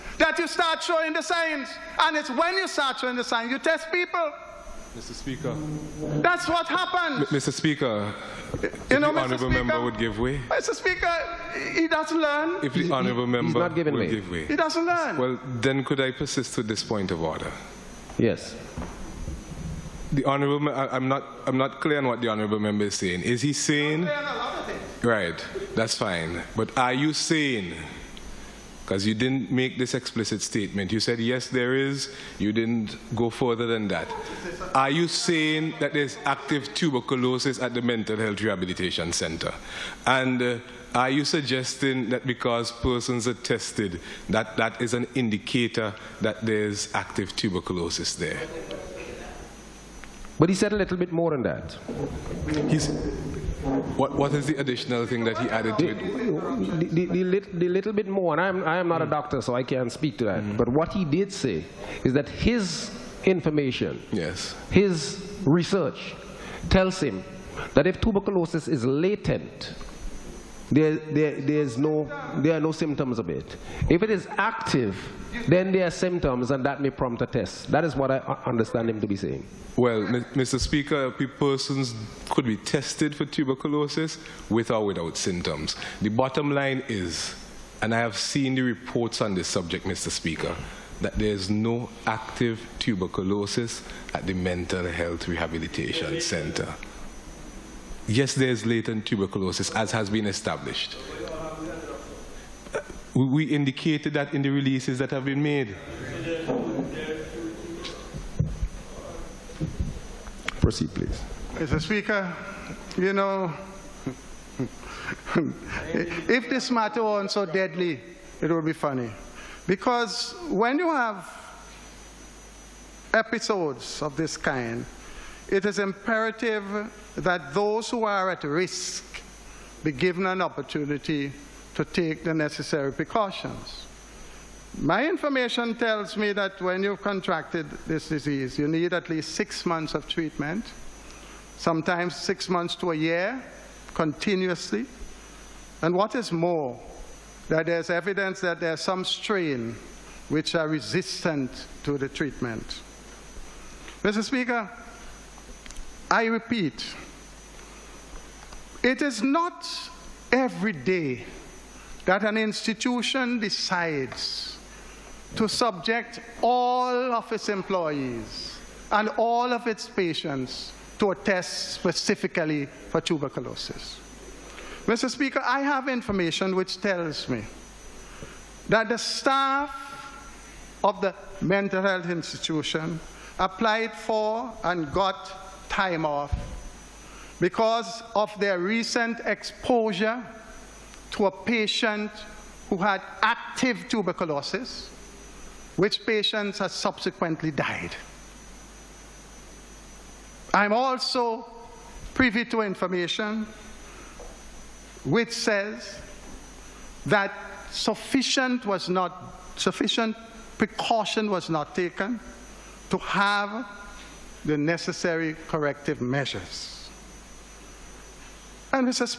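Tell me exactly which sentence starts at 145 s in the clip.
And what is more, that there's evidence that there's some strain which are resistant to the treatment.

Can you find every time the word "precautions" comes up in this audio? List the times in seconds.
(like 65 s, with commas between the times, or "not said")
132 s, 210 s.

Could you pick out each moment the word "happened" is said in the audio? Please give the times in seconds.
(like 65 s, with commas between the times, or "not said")
6 s.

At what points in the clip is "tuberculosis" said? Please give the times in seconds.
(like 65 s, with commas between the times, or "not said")
36 s, 47 s, 67 s, 83 s, 92 s, 99 s, 172 s, 193 s.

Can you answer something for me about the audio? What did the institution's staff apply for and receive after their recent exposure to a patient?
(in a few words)
time off.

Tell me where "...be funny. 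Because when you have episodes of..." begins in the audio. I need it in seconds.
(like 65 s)
118 s.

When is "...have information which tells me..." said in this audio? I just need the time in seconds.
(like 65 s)
175 s.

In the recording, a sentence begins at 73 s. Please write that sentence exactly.
If it is active, then there are symptoms, and that may prompt a test.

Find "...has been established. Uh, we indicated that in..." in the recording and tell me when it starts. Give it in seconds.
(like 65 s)
99 s.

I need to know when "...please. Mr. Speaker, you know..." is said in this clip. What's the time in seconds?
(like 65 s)
110 s.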